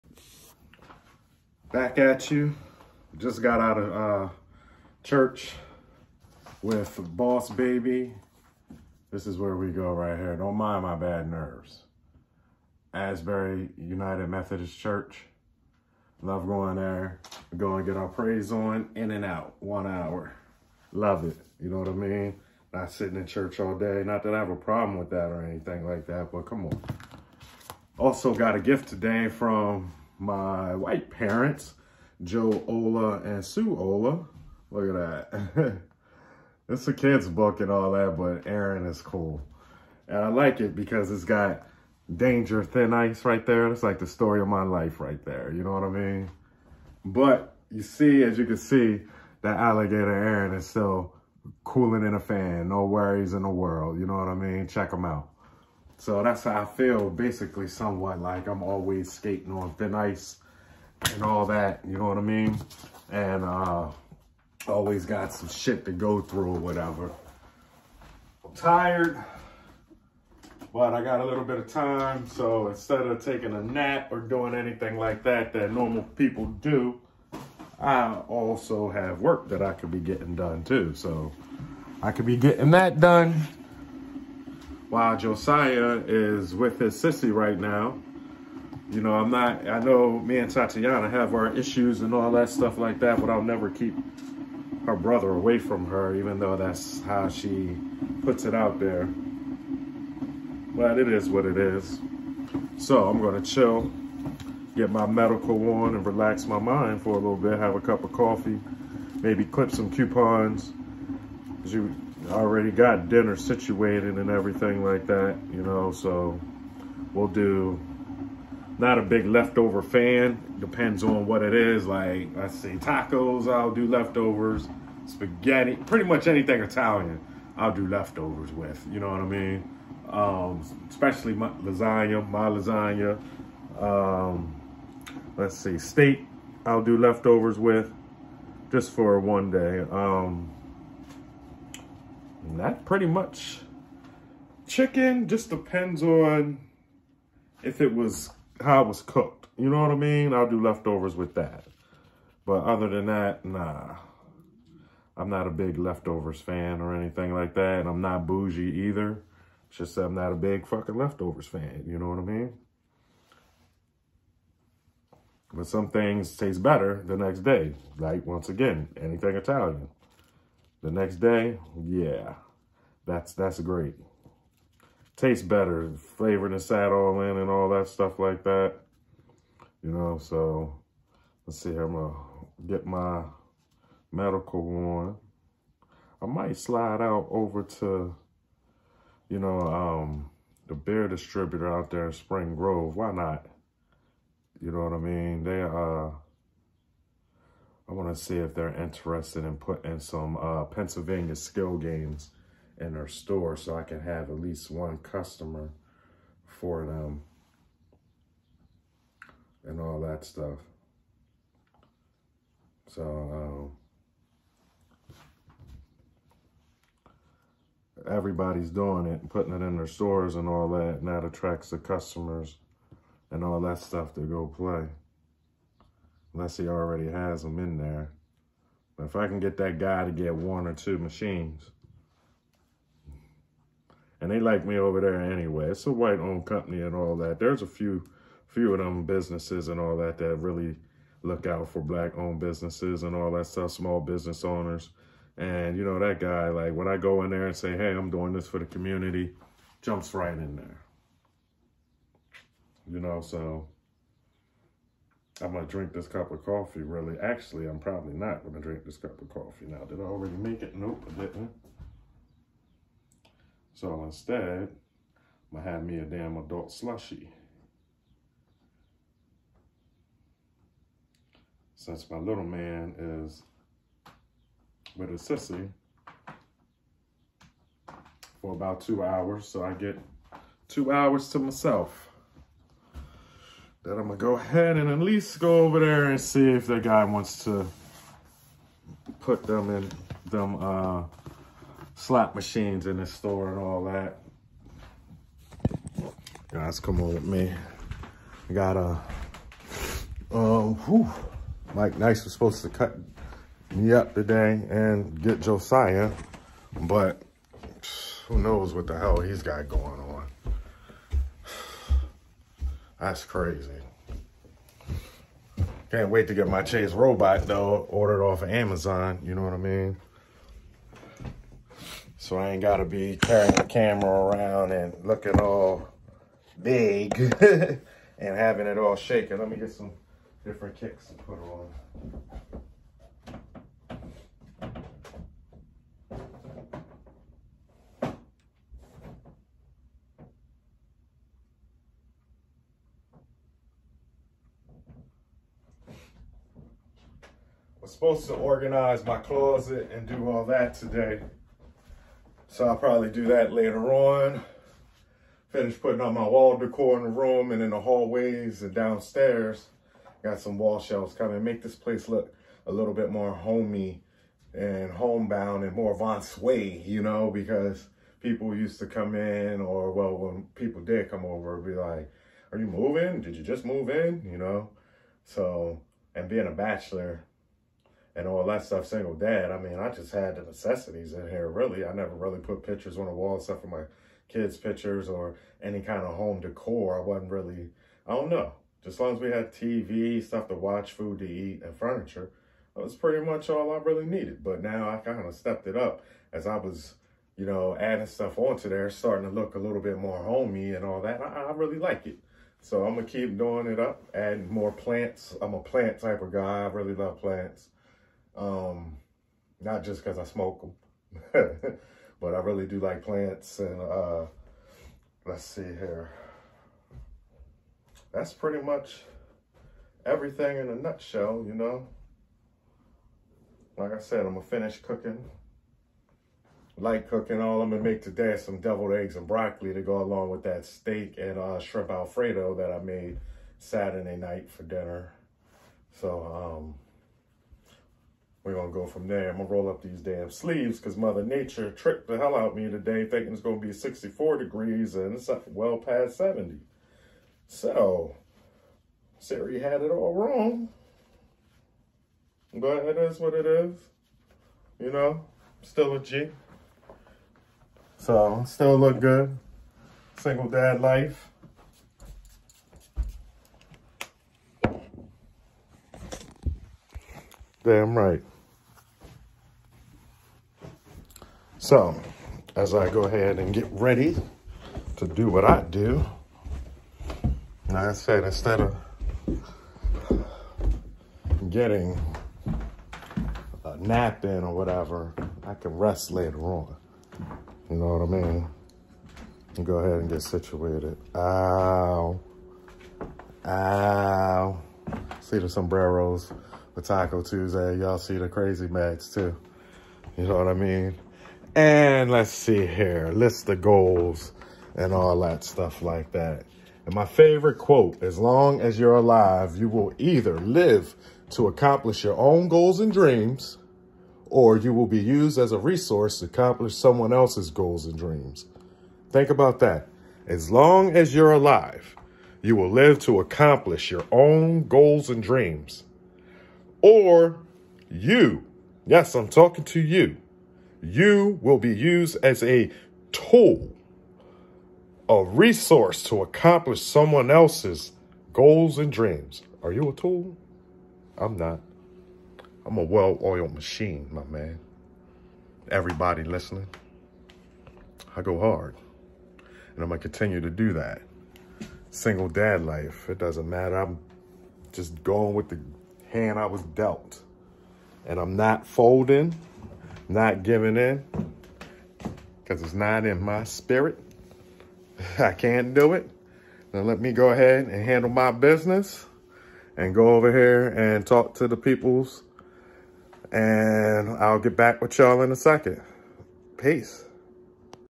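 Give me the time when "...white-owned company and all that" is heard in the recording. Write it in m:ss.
3:55.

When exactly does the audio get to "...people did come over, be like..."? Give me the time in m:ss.
6:10.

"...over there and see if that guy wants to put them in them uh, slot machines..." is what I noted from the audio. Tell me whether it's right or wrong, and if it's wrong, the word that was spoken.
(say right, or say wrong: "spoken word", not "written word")
right.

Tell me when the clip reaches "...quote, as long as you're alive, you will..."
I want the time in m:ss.
8:27.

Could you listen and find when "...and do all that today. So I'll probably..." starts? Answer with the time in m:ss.
5:49.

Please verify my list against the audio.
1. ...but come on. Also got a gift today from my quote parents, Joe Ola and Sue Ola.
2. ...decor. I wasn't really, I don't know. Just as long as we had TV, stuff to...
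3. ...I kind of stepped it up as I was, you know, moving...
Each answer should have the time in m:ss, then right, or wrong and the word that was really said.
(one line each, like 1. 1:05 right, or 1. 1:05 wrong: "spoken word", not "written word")
1. 0:26 wrong: "white", not "quote"
2. 6:26 right
3. 6:34 wrong: "adding", not "moving".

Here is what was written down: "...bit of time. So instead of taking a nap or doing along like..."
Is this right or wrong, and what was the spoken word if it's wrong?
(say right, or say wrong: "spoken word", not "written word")
wrong: "anything", not "along".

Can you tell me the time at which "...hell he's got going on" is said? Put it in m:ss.
5:08.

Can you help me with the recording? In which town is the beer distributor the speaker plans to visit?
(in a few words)
Spring Grove.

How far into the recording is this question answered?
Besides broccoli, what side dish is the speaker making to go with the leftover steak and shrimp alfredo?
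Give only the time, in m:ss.
7:08.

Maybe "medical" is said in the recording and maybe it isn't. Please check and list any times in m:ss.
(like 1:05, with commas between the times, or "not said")
1:45, 3:04.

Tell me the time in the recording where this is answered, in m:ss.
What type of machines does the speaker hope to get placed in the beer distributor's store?
3:20.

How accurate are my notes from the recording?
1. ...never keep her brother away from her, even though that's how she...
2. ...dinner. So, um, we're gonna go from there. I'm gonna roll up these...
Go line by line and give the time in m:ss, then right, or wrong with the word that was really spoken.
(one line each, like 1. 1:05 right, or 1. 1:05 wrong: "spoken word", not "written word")
1. 1:33 right
2. 7:14 right.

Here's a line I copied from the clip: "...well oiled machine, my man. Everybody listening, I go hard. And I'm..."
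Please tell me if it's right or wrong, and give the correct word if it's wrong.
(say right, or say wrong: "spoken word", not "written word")
right.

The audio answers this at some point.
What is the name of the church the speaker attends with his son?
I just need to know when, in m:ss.
0:12.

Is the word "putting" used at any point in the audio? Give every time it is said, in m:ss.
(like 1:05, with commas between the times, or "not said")
3:19, 3:39, 5:55.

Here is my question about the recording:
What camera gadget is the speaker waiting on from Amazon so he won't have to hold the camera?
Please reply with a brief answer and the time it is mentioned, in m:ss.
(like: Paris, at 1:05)
Chase robot, at 5:16.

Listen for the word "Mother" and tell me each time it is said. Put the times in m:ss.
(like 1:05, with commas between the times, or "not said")
7:20.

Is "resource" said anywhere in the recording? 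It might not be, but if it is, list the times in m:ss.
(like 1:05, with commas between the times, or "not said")
8:35, 8:55.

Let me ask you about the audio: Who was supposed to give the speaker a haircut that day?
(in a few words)
Mike Nice.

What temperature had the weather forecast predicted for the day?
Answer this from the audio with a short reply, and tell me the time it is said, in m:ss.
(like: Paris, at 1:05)
64 degrees, at 7:23.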